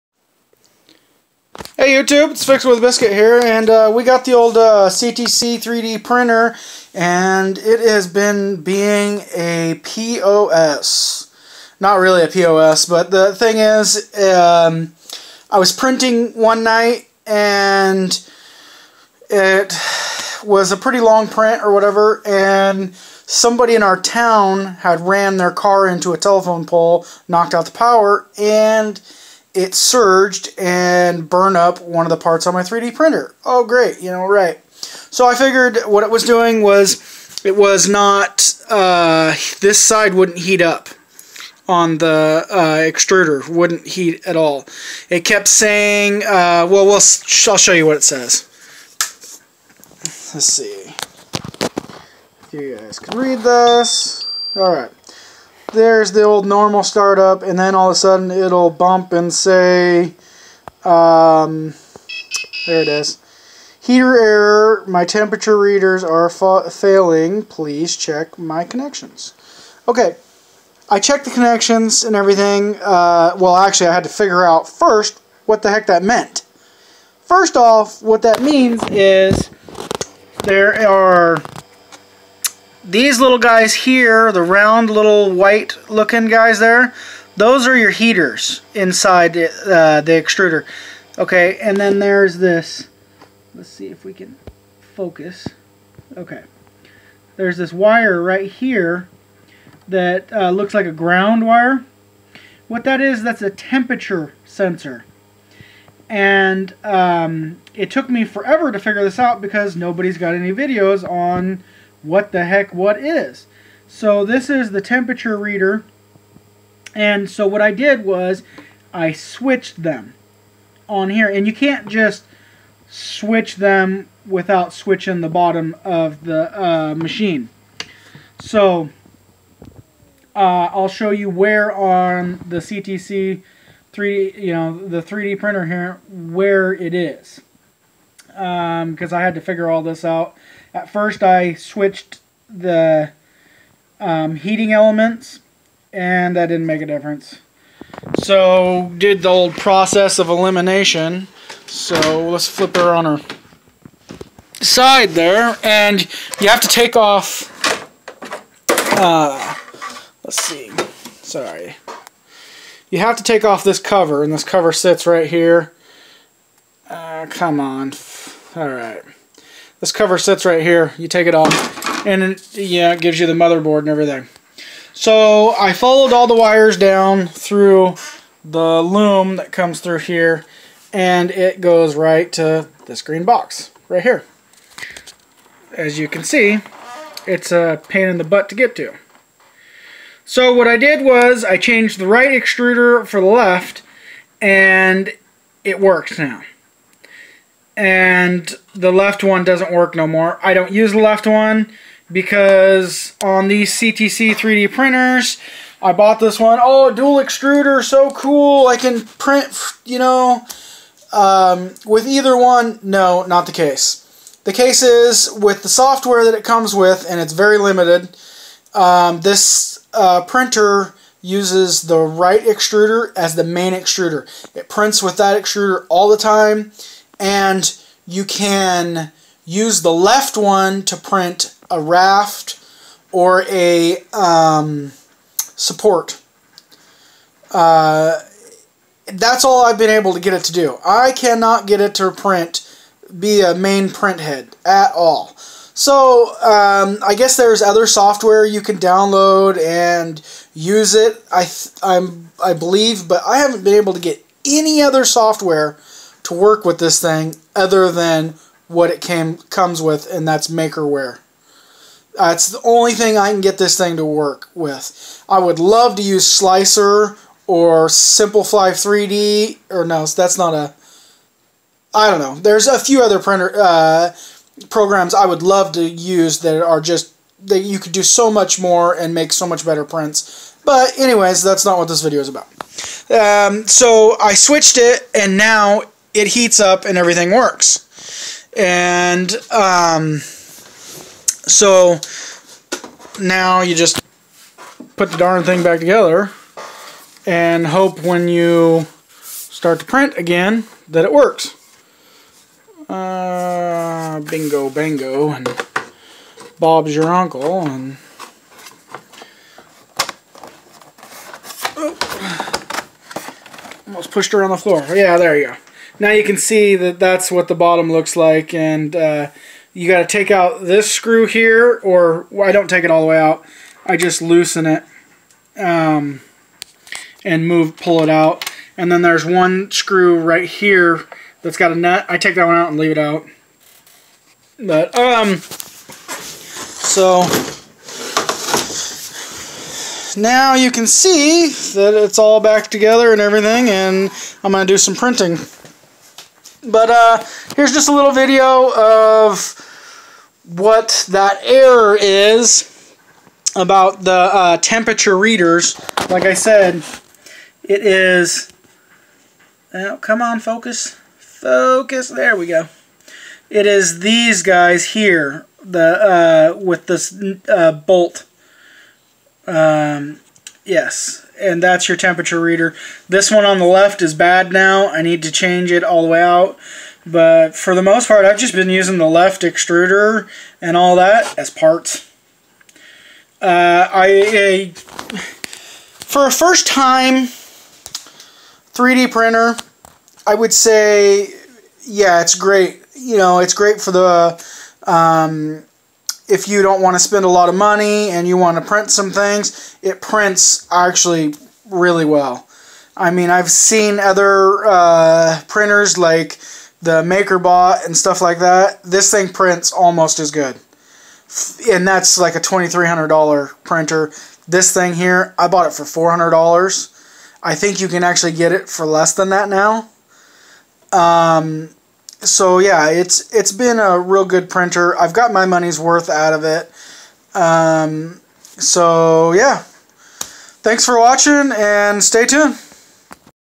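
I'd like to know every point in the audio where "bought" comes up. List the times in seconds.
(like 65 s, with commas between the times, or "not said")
205 s, 415 s.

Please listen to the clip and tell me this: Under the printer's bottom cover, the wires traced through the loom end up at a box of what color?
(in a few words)
Green.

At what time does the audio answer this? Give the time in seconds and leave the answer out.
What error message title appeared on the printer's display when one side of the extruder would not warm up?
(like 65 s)
63 s.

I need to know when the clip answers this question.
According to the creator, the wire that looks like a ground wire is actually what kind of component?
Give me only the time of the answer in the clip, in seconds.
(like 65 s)
103 s.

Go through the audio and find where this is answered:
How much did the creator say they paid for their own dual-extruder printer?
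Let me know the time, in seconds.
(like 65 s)
415 s.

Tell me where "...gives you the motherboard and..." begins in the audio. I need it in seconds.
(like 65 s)
173 s.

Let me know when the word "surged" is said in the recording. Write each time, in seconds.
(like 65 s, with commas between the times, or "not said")
29 s.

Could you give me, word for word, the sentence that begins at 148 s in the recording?
So did the old process of elimination.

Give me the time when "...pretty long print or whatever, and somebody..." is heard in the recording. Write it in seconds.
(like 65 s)
20 s.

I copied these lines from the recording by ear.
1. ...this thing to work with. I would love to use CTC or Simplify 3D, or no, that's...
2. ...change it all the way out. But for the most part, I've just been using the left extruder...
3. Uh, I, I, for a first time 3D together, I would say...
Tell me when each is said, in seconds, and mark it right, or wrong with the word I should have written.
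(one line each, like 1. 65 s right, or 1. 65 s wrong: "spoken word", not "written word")
1. 263 s wrong: "Slicer", not "CTC"
2. 375 s right
3. 383 s wrong: "printer", not "together".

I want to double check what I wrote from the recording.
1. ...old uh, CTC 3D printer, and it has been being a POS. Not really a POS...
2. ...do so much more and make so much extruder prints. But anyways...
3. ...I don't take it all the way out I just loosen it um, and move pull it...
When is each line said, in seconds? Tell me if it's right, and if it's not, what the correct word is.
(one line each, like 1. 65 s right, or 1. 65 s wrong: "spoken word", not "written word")
1. 4 s right
2. 277 s wrong: "better", not "extruder"
3. 322 s right.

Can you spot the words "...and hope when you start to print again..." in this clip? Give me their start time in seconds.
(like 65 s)
297 s.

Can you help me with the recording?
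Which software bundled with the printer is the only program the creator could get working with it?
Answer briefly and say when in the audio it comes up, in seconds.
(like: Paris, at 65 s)
Makerware, at 260 s.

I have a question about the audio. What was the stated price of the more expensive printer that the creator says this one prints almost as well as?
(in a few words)
$2,300.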